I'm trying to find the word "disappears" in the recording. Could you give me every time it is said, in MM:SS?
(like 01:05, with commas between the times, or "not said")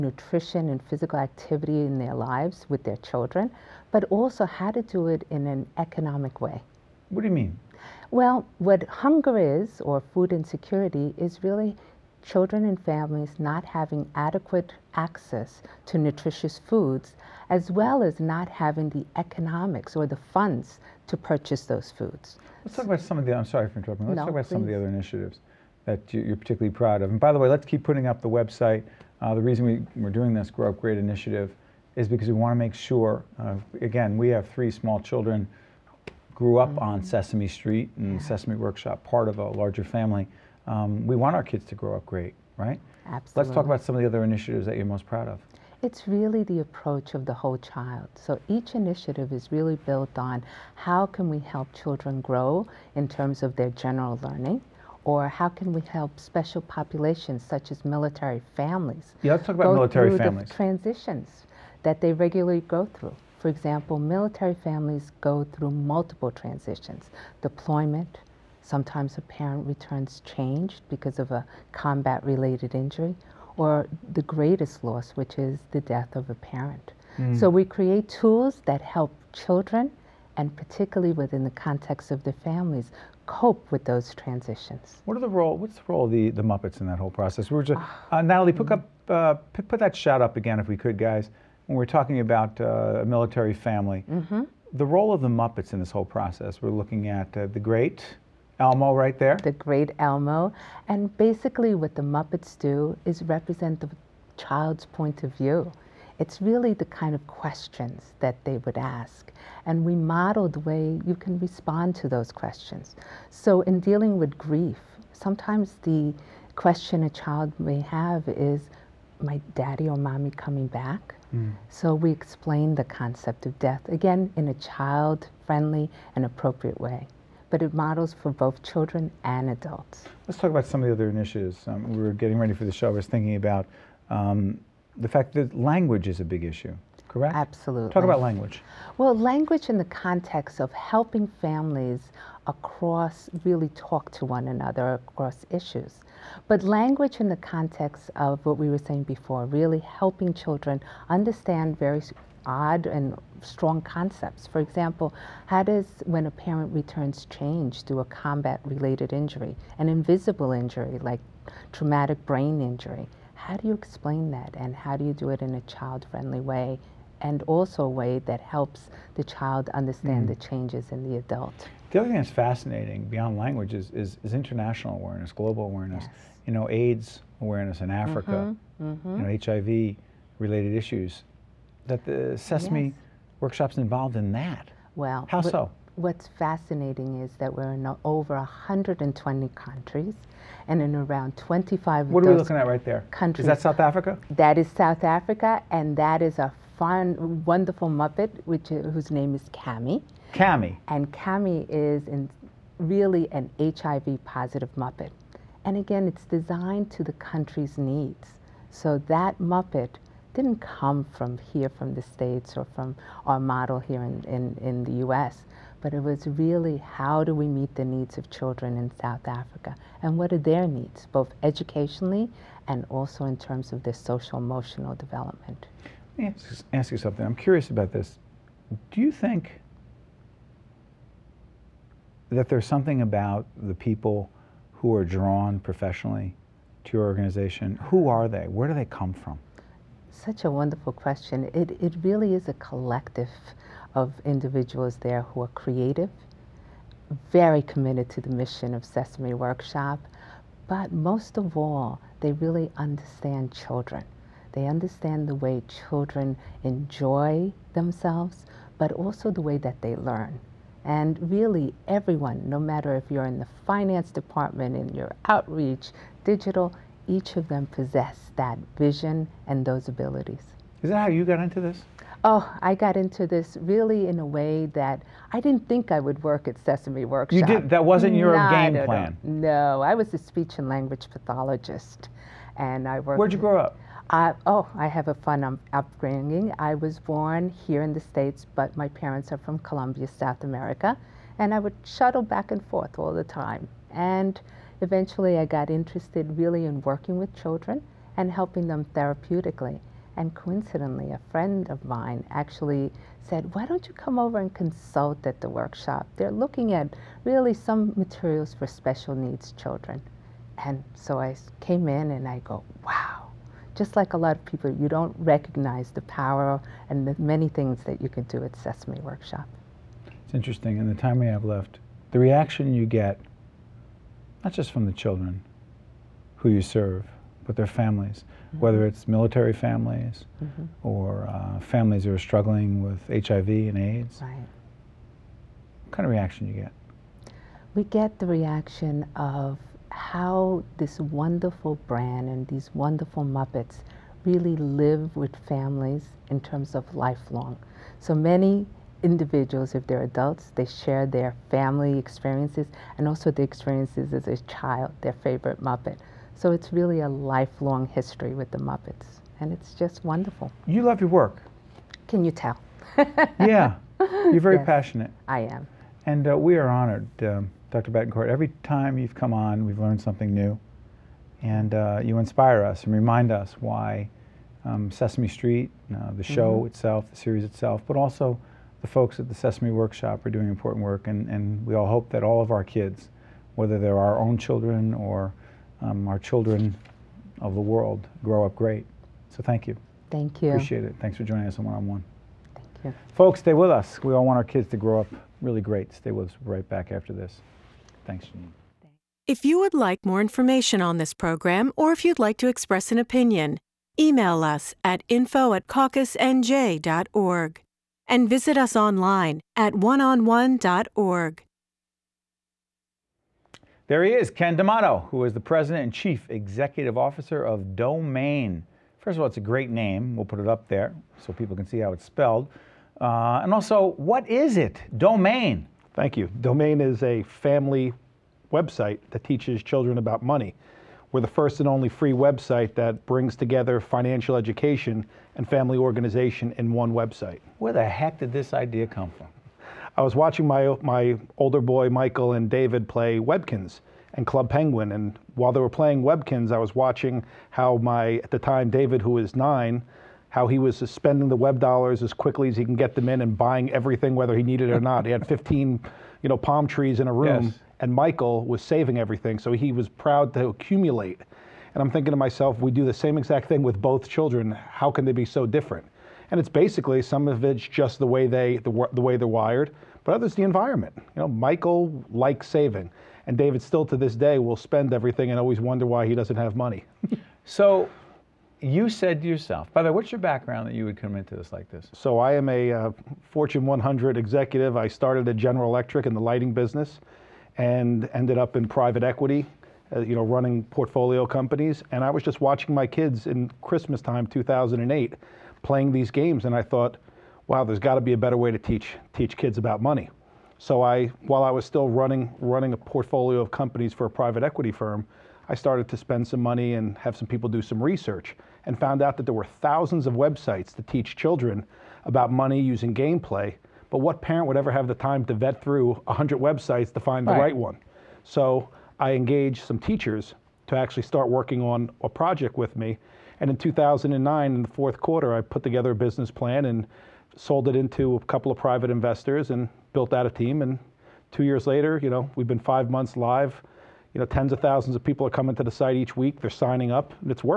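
not said.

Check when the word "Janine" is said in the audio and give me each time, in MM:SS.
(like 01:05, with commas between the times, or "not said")
06:38.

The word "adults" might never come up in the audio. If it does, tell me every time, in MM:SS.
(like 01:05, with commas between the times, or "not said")
02:09, 02:51, 05:50.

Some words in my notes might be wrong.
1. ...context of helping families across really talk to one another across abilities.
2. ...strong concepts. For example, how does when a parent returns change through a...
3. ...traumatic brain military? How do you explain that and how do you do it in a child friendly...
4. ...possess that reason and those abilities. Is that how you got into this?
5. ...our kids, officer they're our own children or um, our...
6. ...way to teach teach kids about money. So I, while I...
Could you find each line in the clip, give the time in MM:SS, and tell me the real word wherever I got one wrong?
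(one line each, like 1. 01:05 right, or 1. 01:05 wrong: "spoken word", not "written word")
1. 02:19 wrong: "issues", not "abilities"
2. 02:33 right
3. 02:41 wrong: "injury", not "military"
4. 04:27 wrong: "vision", not "reason"
5. 06:22 wrong: "whether", not "officer"
6. 08:18 right.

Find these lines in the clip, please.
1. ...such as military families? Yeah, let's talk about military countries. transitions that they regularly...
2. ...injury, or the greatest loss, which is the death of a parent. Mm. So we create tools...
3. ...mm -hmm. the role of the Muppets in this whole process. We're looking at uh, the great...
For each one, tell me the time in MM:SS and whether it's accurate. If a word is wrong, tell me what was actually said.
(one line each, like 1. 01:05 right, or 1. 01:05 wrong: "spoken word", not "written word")
1. 00:57 wrong: "families", not "countries"
2. 01:12 right
3. 01:34 right.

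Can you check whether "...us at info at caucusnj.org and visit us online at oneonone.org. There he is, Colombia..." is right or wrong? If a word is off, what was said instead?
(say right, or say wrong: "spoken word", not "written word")
wrong: "Ken", not "Colombia".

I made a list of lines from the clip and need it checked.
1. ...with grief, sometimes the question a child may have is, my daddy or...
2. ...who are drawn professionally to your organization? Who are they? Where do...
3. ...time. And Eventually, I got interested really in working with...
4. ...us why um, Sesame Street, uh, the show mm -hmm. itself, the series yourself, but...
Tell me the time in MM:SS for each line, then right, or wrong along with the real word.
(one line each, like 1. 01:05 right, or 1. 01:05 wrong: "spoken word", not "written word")
1. 01:54 right
2. 03:54 right
3. 04:53 right
4. 06:13 wrong: "itself", not "yourself".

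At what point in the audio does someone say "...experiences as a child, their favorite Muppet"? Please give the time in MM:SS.
05:53.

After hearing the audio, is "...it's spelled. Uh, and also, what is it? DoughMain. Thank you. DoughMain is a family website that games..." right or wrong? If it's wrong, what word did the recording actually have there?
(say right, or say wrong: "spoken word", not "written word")
wrong: "teaches", not "games".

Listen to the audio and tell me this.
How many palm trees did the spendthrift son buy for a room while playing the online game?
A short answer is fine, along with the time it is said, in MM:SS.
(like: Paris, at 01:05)
15, at 07:35.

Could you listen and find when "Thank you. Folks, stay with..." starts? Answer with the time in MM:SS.
06:32.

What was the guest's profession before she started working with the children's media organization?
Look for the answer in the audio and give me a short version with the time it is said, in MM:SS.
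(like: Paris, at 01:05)
speech and language pathologist, at 04:40.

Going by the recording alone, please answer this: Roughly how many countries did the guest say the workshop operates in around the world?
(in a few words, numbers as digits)
120.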